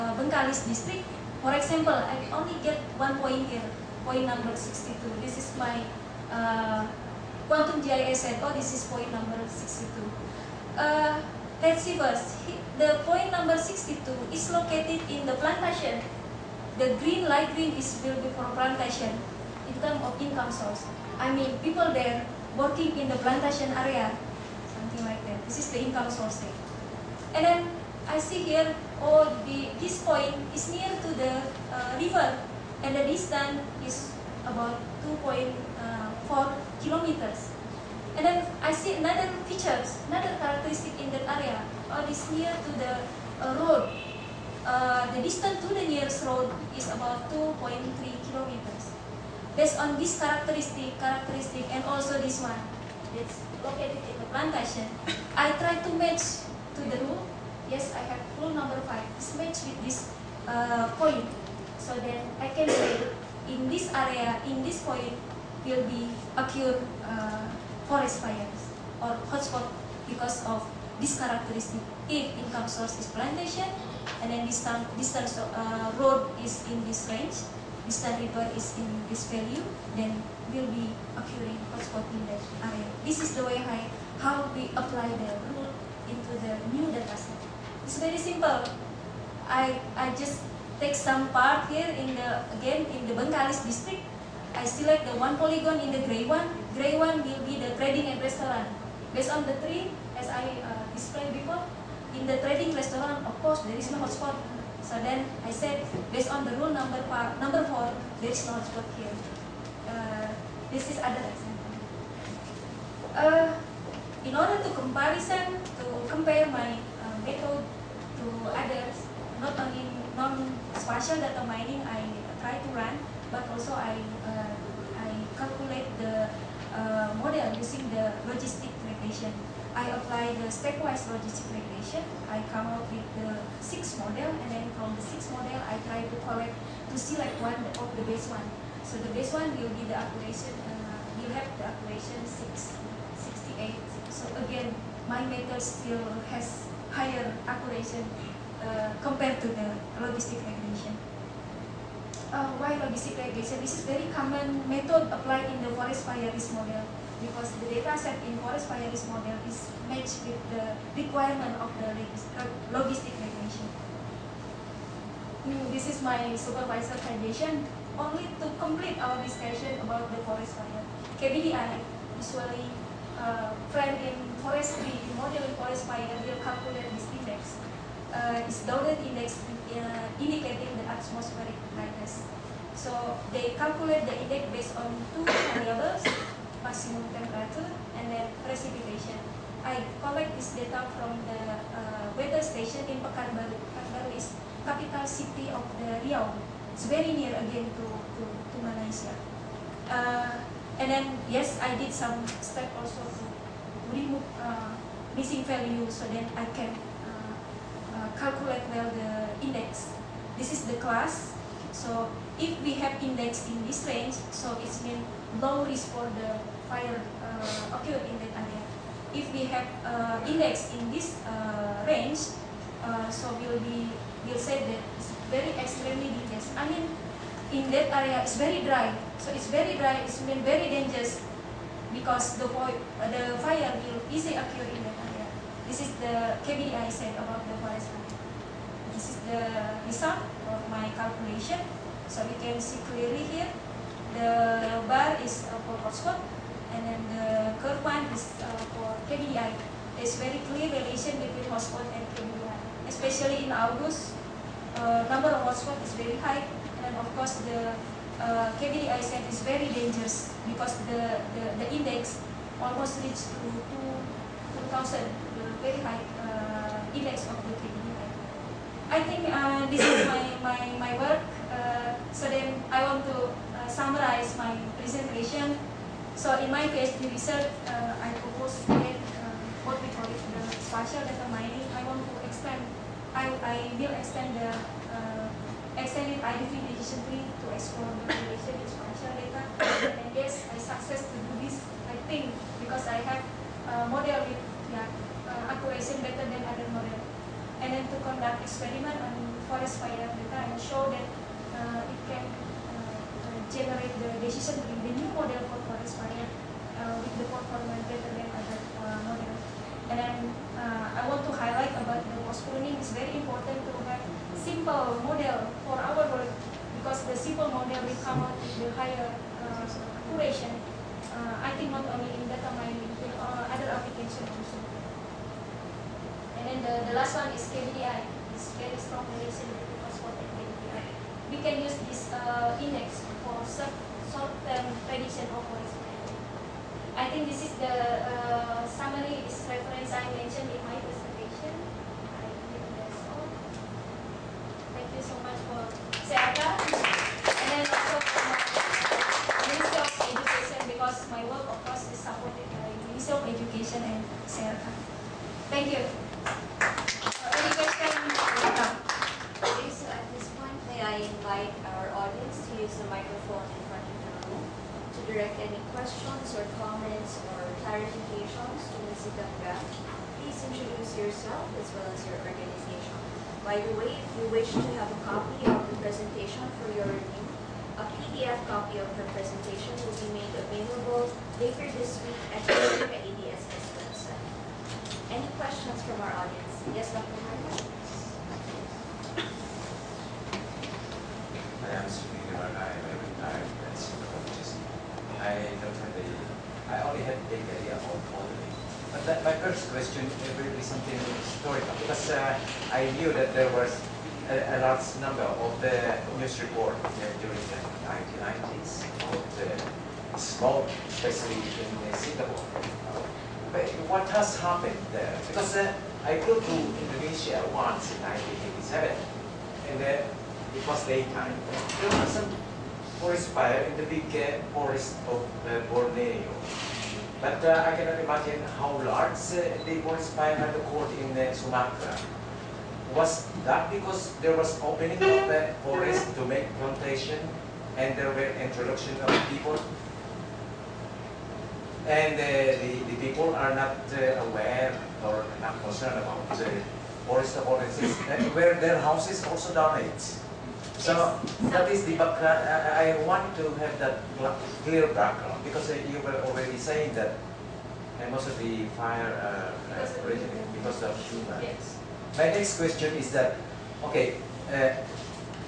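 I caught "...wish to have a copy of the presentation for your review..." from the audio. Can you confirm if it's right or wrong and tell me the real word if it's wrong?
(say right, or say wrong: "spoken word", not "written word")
right.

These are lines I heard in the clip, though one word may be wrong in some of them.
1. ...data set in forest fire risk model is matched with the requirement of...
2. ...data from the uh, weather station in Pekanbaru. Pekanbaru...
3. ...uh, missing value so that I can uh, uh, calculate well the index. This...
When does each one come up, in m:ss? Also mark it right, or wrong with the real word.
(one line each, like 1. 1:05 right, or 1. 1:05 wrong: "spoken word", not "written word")
1. 2:37 right
2. 3:10 right
3. 3:24 right.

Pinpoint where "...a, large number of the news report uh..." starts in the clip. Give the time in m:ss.
6:44.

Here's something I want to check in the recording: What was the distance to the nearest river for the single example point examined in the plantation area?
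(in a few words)
2.4 kilometers.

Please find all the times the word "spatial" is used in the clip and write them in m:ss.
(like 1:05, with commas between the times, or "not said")
2:00, 4:40, 4:48.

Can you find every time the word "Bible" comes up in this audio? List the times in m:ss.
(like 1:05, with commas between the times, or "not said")
not said.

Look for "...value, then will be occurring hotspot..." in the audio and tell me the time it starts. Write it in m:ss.
1:19.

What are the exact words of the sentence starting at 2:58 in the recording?
Uh, it's dotted index uh, indicating the atmospheric brightness.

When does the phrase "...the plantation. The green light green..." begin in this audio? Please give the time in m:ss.
0:15.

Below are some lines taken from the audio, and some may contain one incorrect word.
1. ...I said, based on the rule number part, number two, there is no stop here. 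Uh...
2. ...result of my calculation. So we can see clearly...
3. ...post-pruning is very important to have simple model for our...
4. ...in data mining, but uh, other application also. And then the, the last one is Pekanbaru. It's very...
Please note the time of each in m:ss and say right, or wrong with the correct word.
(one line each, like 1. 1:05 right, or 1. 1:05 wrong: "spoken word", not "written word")
1. 1:45 wrong: "four", not "two"
2. 3:59 right
3. 5:12 right
4. 5:22 wrong: "KDI", not "Pekanbaru".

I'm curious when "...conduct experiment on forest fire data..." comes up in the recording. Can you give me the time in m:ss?
4:57.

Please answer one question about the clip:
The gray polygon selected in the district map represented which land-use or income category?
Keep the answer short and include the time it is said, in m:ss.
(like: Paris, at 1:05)
Trading and restaurant, at 1:37.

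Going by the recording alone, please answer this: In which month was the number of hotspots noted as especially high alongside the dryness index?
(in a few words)
August.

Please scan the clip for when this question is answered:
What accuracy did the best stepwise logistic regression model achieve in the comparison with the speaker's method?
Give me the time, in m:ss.
2:24.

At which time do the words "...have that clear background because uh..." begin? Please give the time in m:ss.
7:33.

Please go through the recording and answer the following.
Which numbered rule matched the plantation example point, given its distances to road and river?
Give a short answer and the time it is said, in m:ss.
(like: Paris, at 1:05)
Rule number five, at 0:58.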